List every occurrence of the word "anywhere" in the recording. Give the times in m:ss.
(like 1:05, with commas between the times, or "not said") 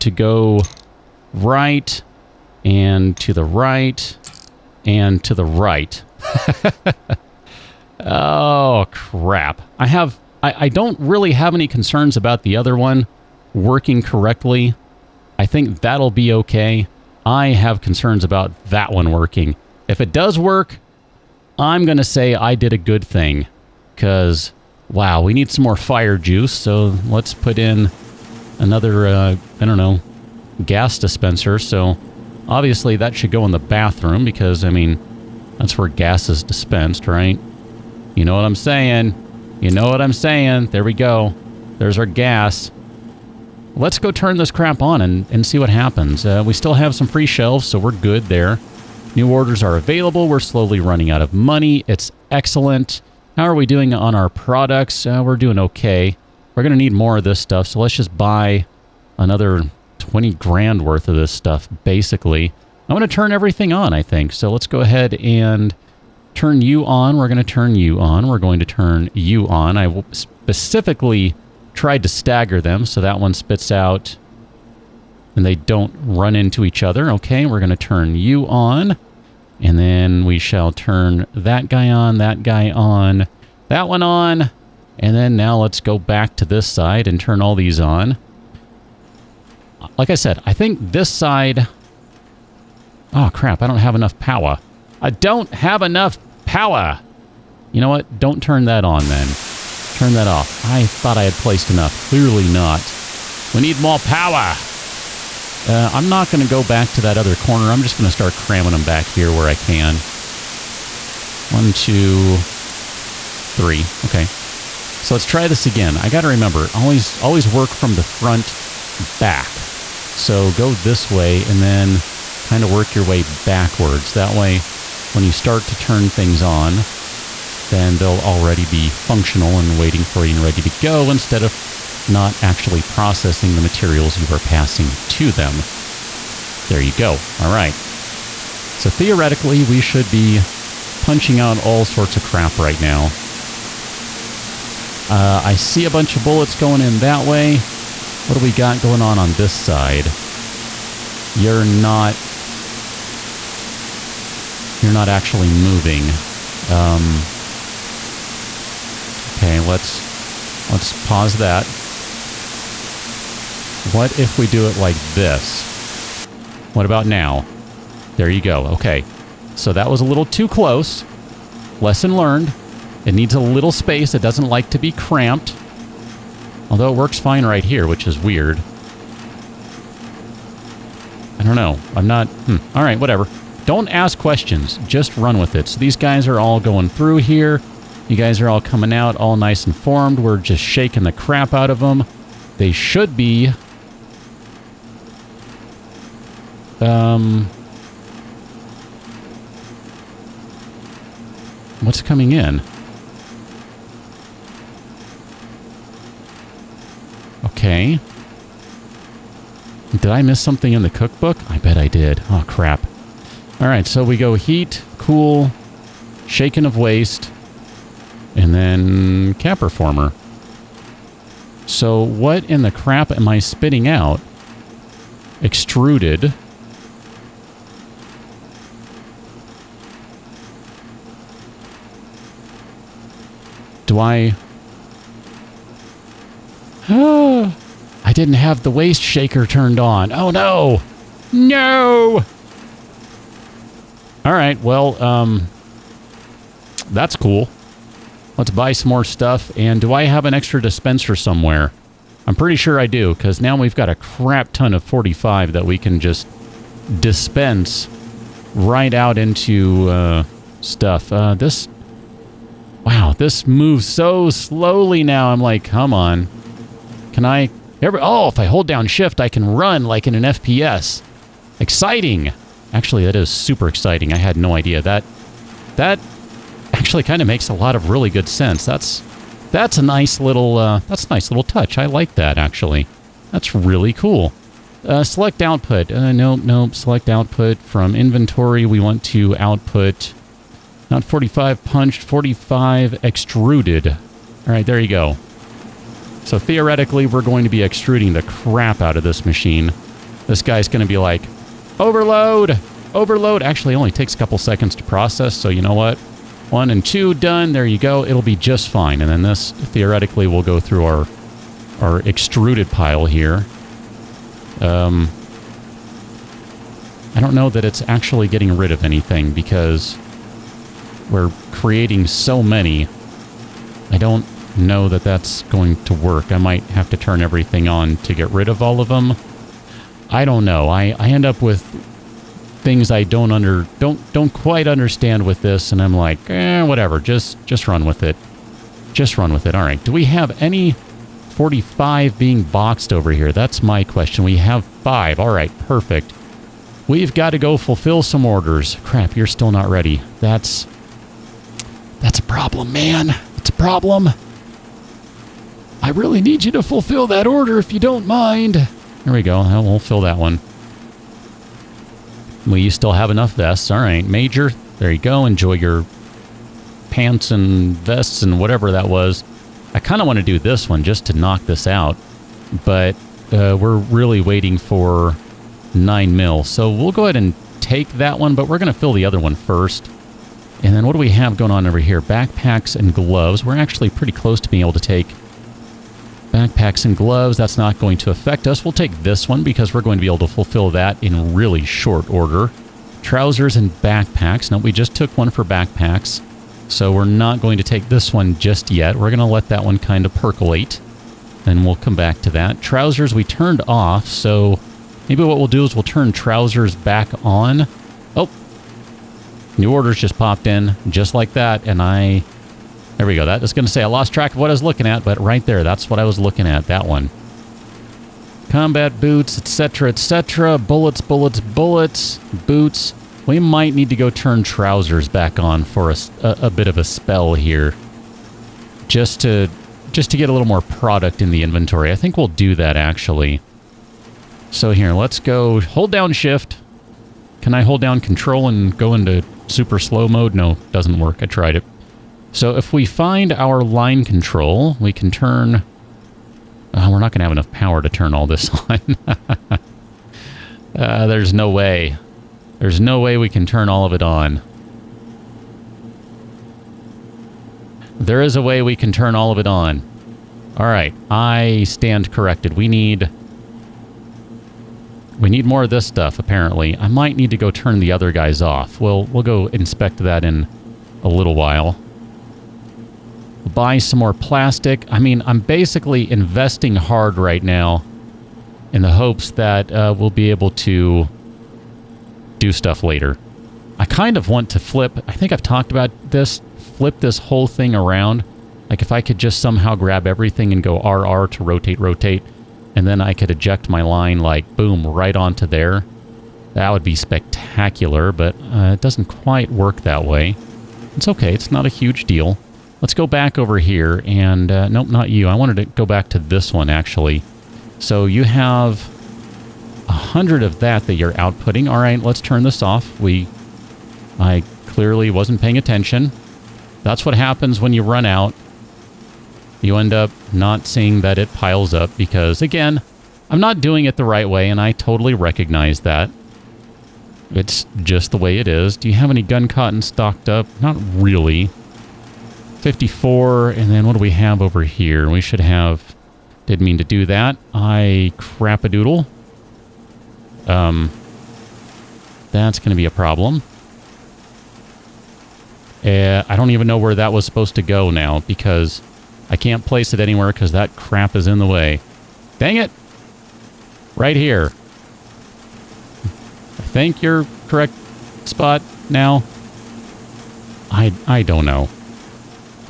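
9:10.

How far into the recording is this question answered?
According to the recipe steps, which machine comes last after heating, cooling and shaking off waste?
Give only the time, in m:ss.
3:39.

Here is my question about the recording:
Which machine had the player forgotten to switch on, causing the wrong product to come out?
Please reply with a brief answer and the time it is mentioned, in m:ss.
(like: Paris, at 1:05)
Waste shaker, at 3:58.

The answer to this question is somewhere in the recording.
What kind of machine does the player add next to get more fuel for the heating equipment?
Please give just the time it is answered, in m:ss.
0:30.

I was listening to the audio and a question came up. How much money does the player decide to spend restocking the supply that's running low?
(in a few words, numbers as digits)
20 grand.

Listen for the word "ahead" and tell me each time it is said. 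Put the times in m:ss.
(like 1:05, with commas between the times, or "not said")
1:04, 6:17.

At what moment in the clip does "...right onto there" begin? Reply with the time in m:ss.
8:14.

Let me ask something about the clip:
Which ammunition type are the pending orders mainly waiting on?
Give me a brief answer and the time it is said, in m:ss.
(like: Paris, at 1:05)
9 mil, at 6:15.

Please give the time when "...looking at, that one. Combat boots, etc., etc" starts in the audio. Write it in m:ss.
6:56.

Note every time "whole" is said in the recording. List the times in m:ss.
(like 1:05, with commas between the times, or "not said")
8:07.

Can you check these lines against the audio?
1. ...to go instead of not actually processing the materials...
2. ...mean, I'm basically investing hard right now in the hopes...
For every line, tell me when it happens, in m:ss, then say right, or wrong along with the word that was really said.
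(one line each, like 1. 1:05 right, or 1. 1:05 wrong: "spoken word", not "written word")
1. 2:10 right
2. 7:54 right.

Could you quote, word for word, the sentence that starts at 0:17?
I have concerns about that one working.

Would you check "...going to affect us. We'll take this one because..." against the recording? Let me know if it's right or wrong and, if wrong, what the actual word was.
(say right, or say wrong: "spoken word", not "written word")
right.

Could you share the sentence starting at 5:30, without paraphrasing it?
I, I end up with things I don't under don't don't quite understand with this, and I'm like, eh, whatever.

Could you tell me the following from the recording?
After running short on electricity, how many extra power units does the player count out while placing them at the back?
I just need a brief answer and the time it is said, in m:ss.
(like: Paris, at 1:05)
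3, at 1:51.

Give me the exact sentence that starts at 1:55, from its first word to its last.
I got to remember, always, always work from the front back.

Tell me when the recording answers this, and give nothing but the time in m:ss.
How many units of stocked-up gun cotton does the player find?
8:52.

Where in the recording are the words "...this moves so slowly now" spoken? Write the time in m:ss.
4:23.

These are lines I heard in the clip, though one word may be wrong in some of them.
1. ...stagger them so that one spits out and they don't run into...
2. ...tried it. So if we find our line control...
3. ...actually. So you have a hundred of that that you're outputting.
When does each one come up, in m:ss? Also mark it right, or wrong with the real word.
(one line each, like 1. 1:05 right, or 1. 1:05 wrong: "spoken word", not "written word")
1. 1:12 right
2. 7:21 right
3. 8:26 right.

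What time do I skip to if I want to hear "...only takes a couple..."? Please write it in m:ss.
5:03.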